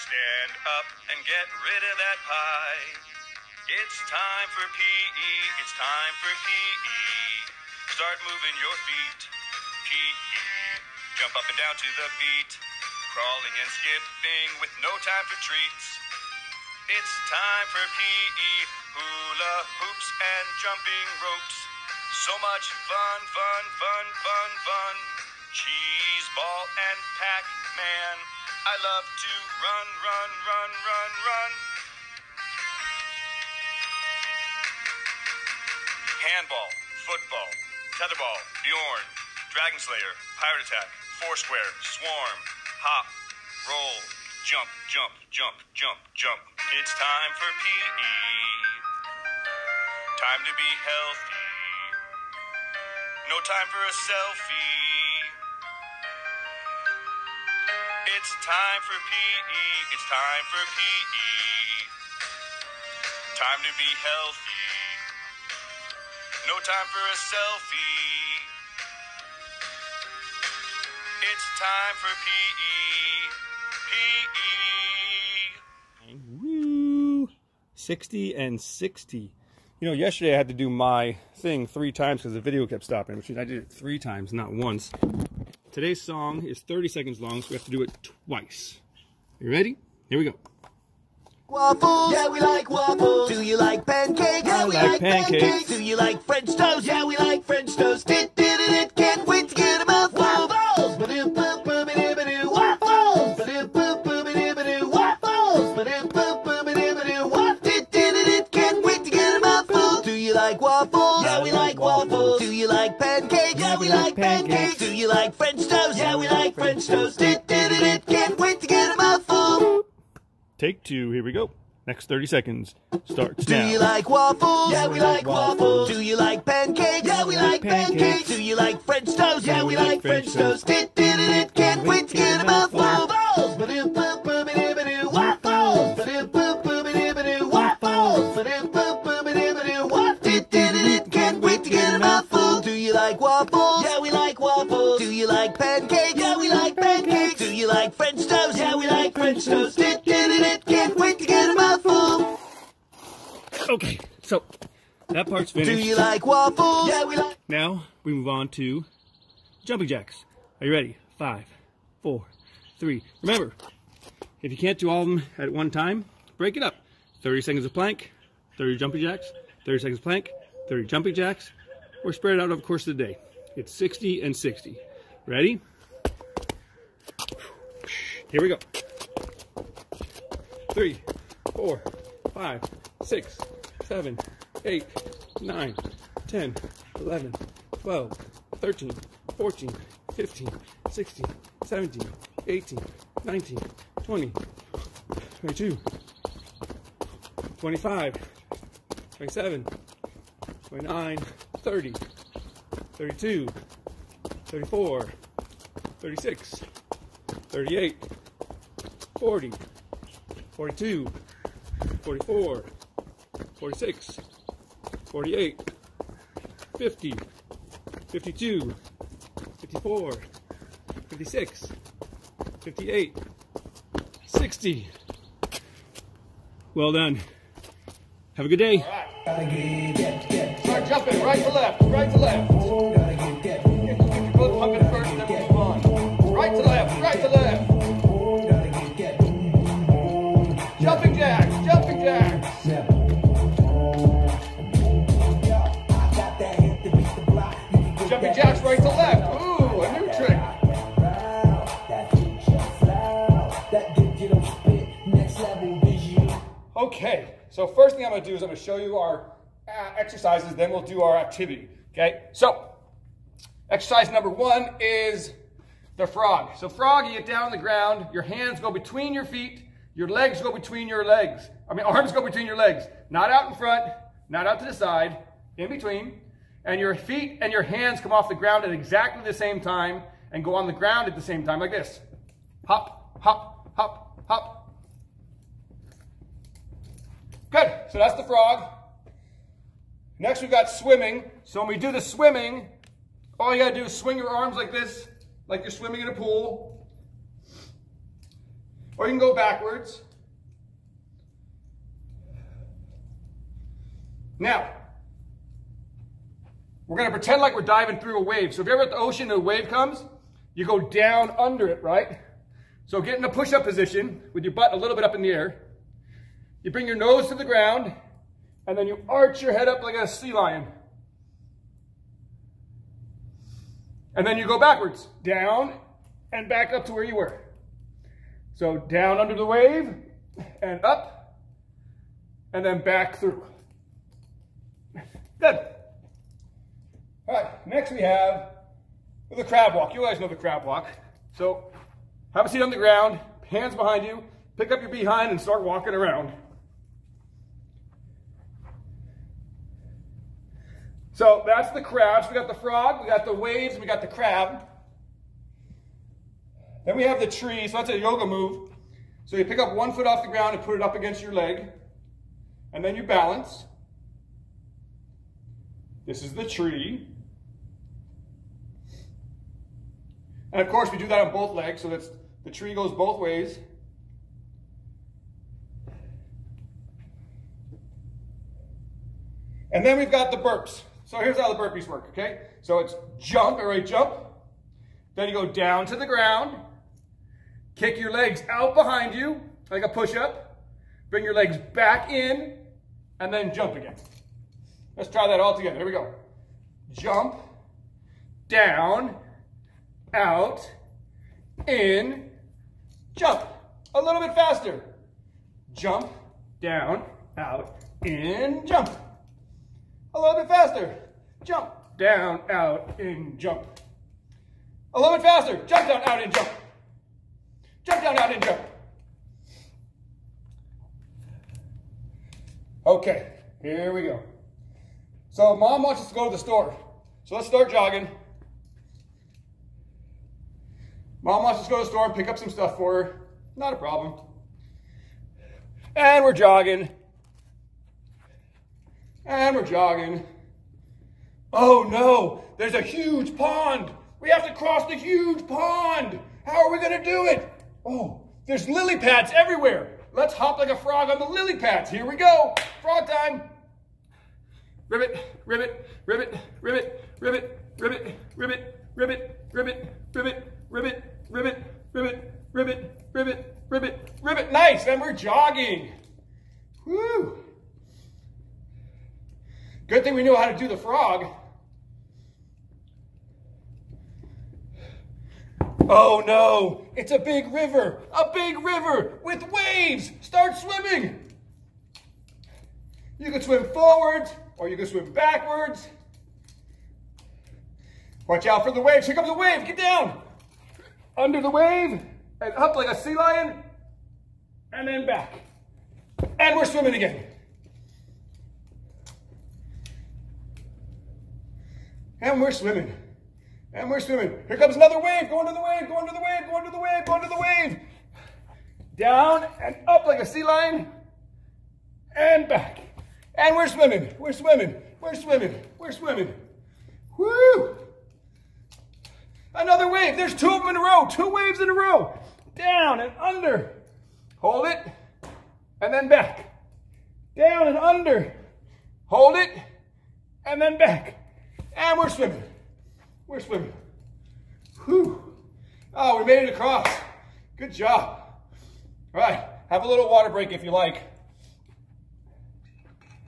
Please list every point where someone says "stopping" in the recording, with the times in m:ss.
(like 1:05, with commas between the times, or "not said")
1:22.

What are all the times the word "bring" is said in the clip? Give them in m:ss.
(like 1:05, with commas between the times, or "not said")
5:16, 6:31.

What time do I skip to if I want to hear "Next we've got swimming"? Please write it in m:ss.
4:50.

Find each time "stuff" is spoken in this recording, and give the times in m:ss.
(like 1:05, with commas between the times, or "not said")
7:12.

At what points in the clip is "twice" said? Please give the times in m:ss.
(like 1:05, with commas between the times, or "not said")
1:28.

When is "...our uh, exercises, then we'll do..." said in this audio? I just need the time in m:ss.
4:18.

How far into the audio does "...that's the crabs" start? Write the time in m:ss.
5:51.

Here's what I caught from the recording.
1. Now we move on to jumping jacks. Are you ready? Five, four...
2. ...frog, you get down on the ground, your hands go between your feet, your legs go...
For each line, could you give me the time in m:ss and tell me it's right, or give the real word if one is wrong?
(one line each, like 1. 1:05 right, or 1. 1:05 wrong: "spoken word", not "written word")
1. 2:37 right
2. 4:26 right.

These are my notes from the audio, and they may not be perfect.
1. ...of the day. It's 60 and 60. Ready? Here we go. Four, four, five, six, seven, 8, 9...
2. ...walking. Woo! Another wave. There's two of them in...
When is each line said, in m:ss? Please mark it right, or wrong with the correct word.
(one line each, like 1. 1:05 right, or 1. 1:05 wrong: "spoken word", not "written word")
1. 2:52 wrong: "Three", not "Four"
2. 8:35 wrong: "swimming", not "walking".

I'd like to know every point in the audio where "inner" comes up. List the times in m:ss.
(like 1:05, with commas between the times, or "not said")
not said.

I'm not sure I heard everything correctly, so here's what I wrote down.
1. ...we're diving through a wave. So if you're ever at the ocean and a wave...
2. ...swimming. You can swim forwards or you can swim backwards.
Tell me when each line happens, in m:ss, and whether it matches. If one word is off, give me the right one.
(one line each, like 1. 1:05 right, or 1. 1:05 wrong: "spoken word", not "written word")
1. 5:07 right
2. 8:00 right.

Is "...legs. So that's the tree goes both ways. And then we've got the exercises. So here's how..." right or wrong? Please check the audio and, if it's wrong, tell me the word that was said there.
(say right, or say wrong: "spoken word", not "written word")
wrong: "burpees", not "exercises".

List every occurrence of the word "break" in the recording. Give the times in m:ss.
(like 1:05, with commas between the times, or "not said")
2:46, 9:00.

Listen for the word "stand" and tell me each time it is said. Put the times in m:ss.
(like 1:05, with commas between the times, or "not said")
0:00.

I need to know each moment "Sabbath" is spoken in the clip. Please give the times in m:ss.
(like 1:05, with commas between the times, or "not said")
not said.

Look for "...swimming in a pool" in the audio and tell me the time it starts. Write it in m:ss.
4:55.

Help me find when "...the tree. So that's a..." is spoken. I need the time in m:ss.
5:57.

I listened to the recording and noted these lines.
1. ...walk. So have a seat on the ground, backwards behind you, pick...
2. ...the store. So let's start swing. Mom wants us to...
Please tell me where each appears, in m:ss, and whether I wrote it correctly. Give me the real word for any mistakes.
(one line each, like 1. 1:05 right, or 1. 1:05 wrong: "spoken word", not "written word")
1. 5:40 wrong: "hands", not "backwards"
2. 7:06 wrong: "jogging", not "swing".